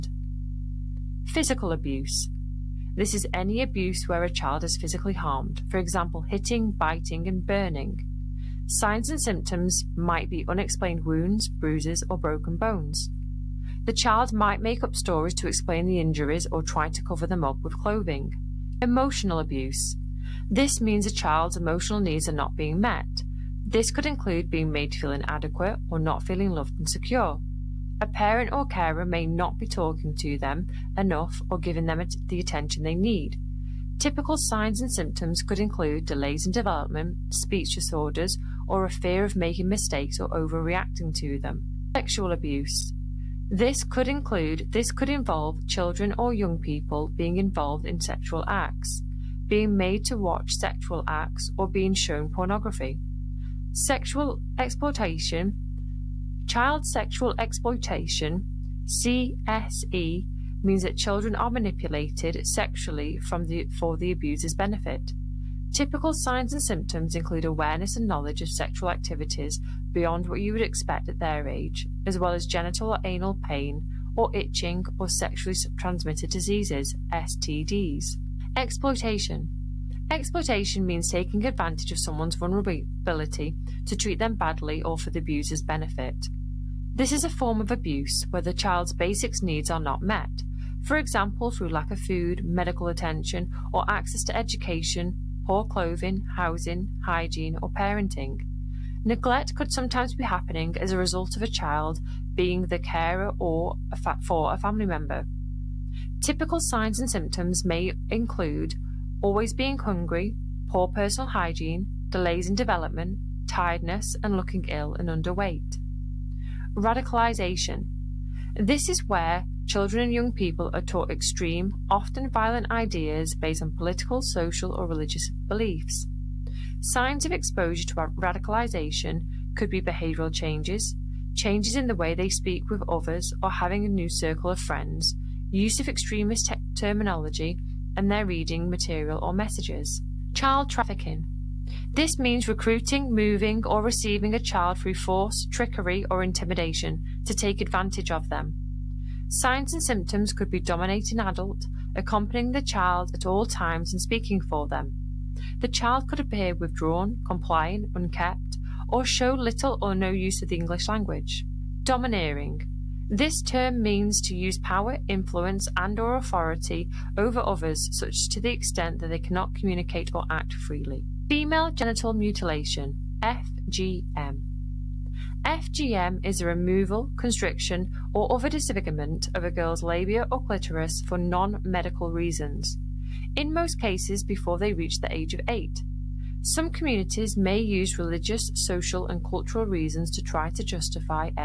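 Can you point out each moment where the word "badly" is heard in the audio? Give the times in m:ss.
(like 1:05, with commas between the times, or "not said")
1:24.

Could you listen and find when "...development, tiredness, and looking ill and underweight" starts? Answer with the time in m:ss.
1:52.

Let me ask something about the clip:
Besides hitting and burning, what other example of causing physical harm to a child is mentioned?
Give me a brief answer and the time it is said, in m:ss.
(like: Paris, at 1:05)
Biting, at 0:06.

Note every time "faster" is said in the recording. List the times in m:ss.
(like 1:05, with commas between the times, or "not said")
not said.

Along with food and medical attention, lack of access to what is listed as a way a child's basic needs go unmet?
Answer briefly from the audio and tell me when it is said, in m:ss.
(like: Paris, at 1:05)
Education, at 1:34.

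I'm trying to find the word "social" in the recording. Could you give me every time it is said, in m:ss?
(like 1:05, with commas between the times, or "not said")
2:04, 3:08.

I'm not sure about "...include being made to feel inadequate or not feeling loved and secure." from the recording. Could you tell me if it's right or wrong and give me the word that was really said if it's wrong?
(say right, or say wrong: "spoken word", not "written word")
right.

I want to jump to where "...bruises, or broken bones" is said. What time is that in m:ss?
0:11.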